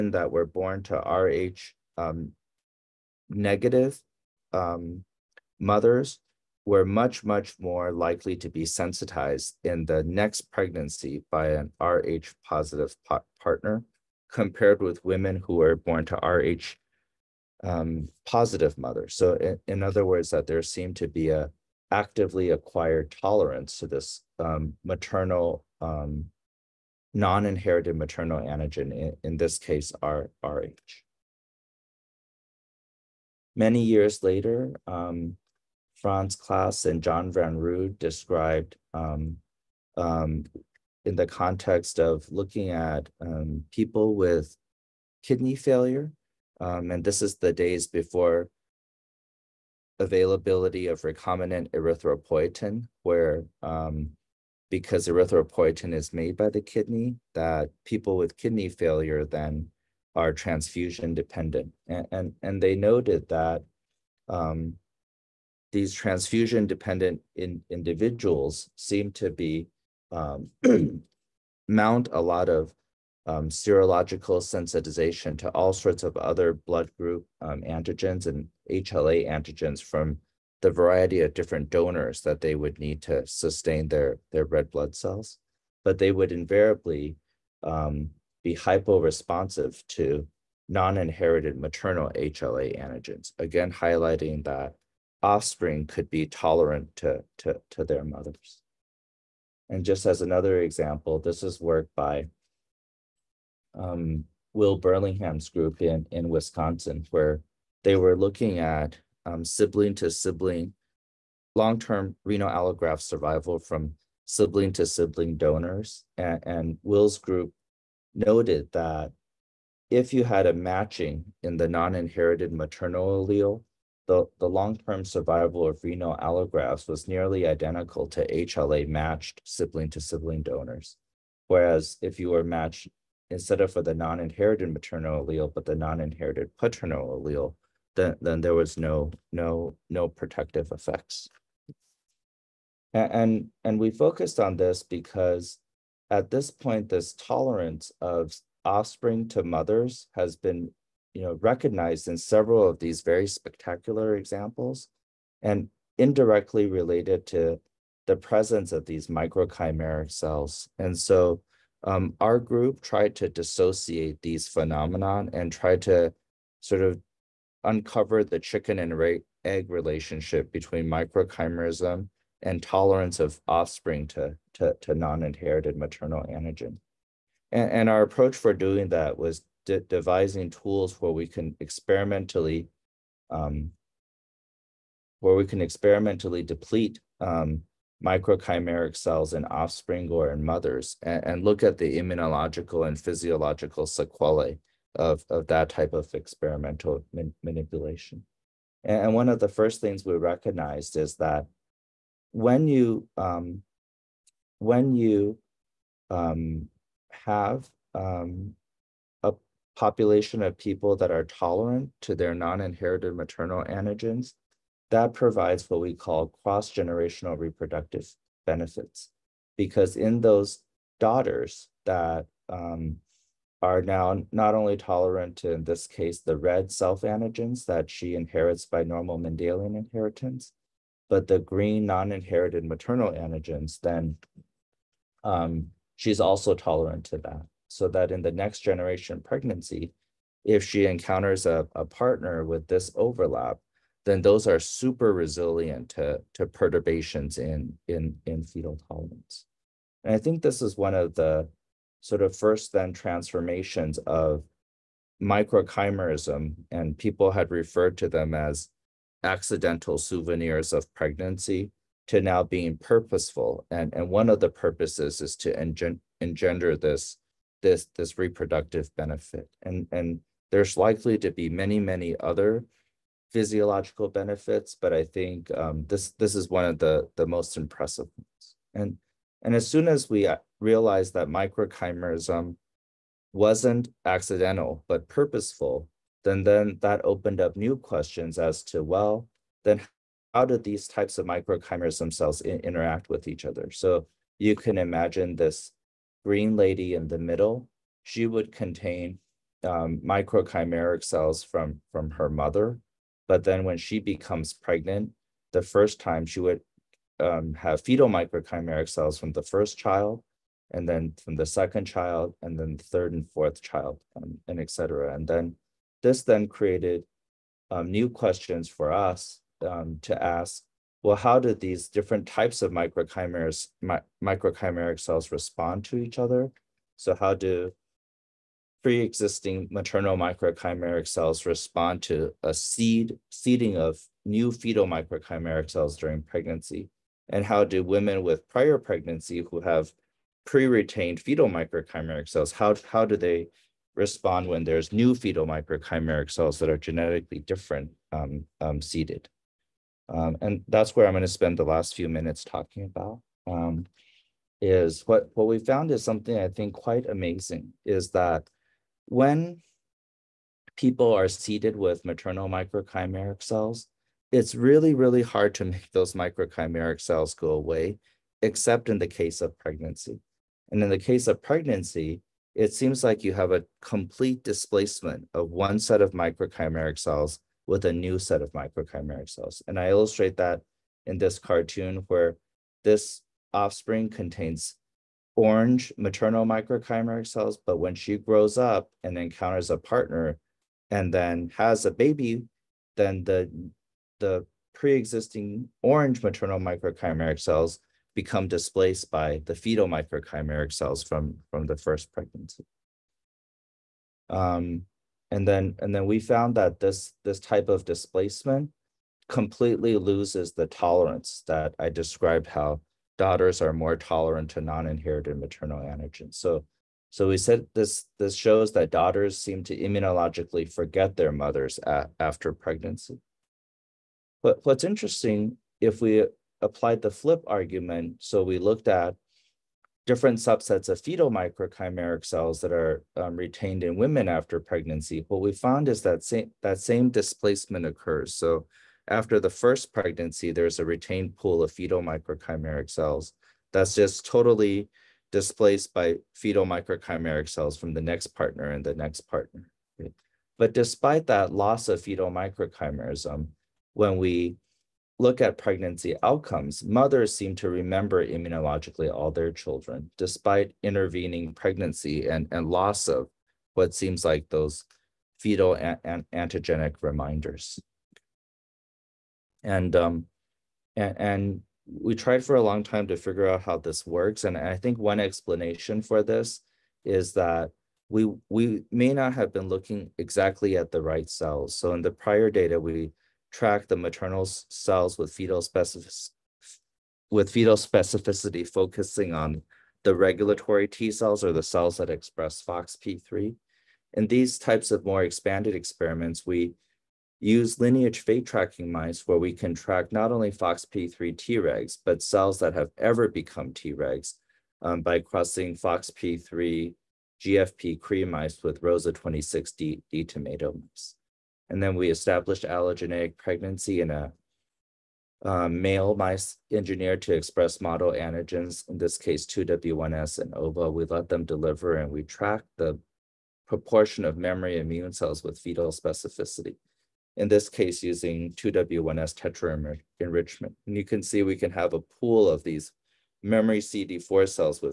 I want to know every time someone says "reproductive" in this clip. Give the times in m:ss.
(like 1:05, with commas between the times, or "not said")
3:37, 4:28.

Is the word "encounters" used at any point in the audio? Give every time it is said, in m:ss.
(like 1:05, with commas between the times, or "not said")
4:00, 6:29.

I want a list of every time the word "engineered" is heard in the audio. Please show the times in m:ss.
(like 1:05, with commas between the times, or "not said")
8:36.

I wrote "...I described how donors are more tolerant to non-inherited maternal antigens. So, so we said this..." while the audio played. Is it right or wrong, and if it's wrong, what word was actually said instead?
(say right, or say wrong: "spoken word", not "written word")
wrong: "daughters", not "donors".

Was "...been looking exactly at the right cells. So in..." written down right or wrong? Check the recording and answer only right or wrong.
right.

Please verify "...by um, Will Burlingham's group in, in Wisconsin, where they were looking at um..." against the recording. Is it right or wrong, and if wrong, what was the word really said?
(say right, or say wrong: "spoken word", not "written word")
right.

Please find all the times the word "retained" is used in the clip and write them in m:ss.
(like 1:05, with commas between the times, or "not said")
5:40, 7:13, 7:20.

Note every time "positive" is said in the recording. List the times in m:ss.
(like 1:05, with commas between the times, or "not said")
0:12, 0:18.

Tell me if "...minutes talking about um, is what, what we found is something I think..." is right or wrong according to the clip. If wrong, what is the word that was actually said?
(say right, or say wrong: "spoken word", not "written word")
right.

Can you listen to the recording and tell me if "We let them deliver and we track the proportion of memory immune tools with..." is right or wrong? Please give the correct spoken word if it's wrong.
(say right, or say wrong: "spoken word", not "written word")
wrong: "cells", not "tools".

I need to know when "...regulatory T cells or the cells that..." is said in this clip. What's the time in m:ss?
8:10.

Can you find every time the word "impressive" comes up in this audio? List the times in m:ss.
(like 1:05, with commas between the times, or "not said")
4:37.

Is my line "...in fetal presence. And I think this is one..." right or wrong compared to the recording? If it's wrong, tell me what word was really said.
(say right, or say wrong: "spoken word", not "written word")
wrong: "tolerance", not "presence".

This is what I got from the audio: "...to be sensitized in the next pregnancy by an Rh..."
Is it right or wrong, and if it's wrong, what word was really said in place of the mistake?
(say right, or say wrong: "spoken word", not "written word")
right.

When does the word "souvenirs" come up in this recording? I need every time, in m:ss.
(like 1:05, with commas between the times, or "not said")
4:19.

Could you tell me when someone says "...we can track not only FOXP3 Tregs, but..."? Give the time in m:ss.
8:19.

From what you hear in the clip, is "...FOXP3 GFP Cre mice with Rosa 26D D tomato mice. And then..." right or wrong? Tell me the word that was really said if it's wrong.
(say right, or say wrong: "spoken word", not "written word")
right.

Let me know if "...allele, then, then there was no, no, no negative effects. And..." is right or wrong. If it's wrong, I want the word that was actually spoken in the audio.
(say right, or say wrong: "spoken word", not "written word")
wrong: "protective", not "negative".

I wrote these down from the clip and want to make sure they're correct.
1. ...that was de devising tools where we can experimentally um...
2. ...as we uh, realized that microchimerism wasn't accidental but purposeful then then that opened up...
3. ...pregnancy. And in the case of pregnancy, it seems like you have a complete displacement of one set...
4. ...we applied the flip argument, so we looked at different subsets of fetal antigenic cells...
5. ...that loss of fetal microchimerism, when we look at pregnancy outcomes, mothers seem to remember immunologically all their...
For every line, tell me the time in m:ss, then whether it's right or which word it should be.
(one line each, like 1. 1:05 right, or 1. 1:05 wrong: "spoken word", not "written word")
1. 2:58 right
2. 4:39 right
3. 6:09 right
4. 7:06 wrong: "microchimeric", not "antigenic"
5. 7:31 right.